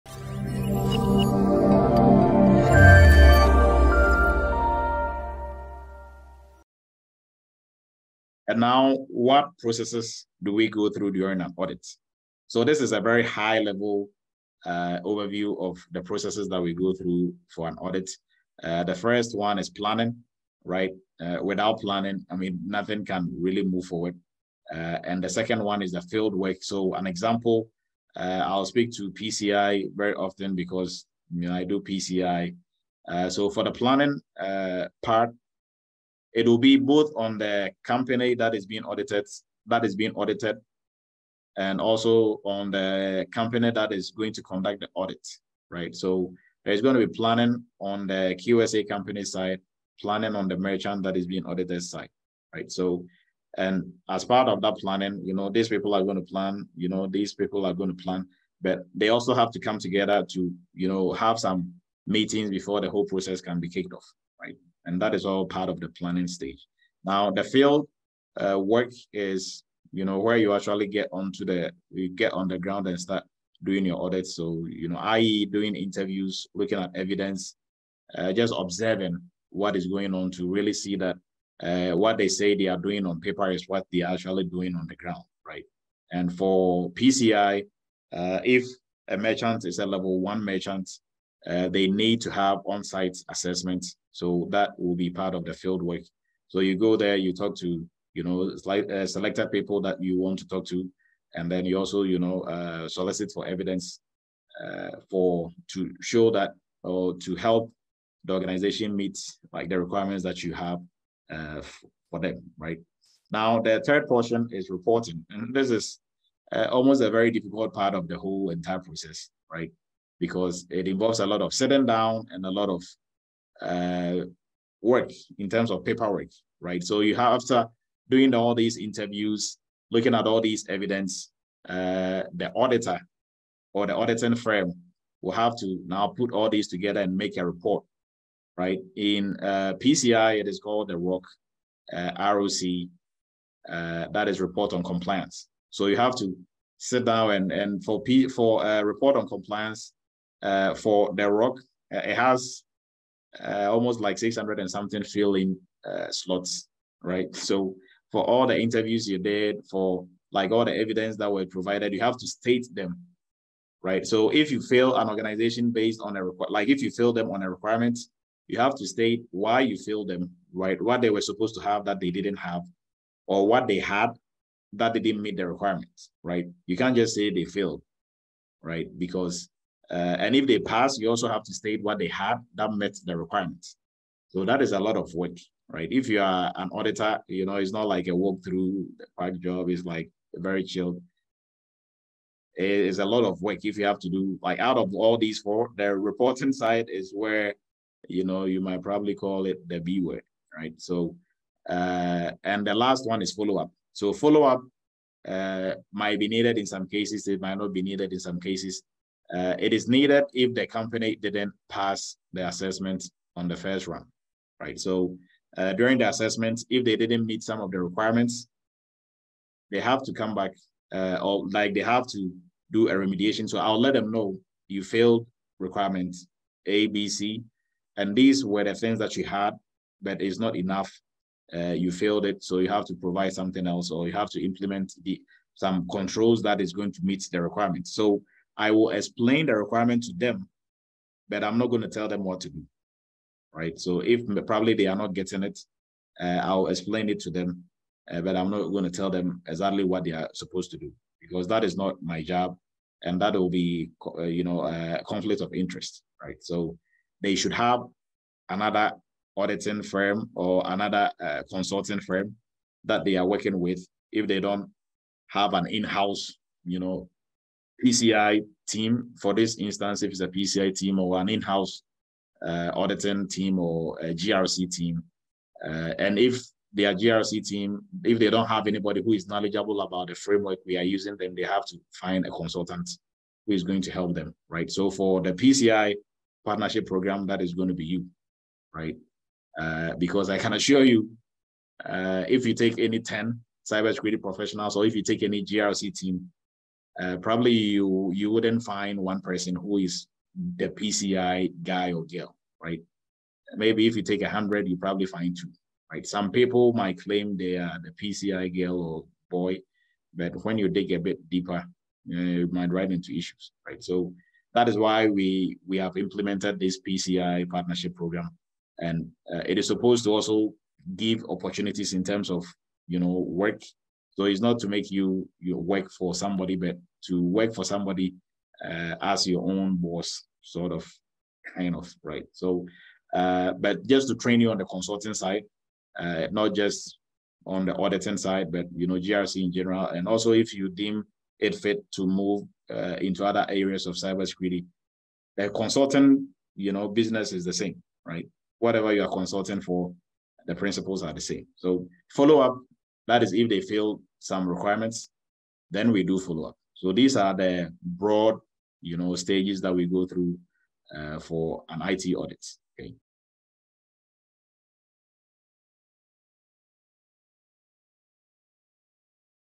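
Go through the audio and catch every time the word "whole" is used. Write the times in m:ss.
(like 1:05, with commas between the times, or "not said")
1:02, 1:58.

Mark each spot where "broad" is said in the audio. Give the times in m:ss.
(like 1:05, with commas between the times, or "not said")
5:57.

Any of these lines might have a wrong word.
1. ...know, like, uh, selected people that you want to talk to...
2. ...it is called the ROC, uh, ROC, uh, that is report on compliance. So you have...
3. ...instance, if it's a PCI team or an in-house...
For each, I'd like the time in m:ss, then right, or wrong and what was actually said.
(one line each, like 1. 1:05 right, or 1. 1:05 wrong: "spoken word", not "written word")
1. 1:38 right
2. 2:20 right
3. 4:29 right.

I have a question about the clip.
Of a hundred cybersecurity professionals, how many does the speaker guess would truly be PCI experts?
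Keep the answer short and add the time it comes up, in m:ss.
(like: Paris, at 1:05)
2, at 5:05.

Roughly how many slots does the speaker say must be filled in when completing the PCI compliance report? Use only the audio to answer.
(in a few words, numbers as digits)
600 and something.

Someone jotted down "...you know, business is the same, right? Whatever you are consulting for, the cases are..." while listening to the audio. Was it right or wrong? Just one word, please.
wrong.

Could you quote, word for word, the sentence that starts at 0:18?
Uh, the first one is planning, right?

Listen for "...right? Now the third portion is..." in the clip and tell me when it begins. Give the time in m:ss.
1:52.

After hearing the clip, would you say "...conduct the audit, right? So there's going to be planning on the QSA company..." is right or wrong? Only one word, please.
right.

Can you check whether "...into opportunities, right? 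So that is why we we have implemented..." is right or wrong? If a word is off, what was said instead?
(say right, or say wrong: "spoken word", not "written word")
wrong: "issues", not "opportunities".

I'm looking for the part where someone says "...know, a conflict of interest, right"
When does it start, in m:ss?
4:14.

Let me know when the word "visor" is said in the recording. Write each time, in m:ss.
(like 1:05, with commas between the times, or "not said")
not said.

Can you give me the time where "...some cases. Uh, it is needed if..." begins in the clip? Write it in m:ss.
3:28.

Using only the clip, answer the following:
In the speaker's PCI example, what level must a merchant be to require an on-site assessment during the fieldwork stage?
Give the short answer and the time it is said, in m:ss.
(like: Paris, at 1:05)
Level one, at 1:29.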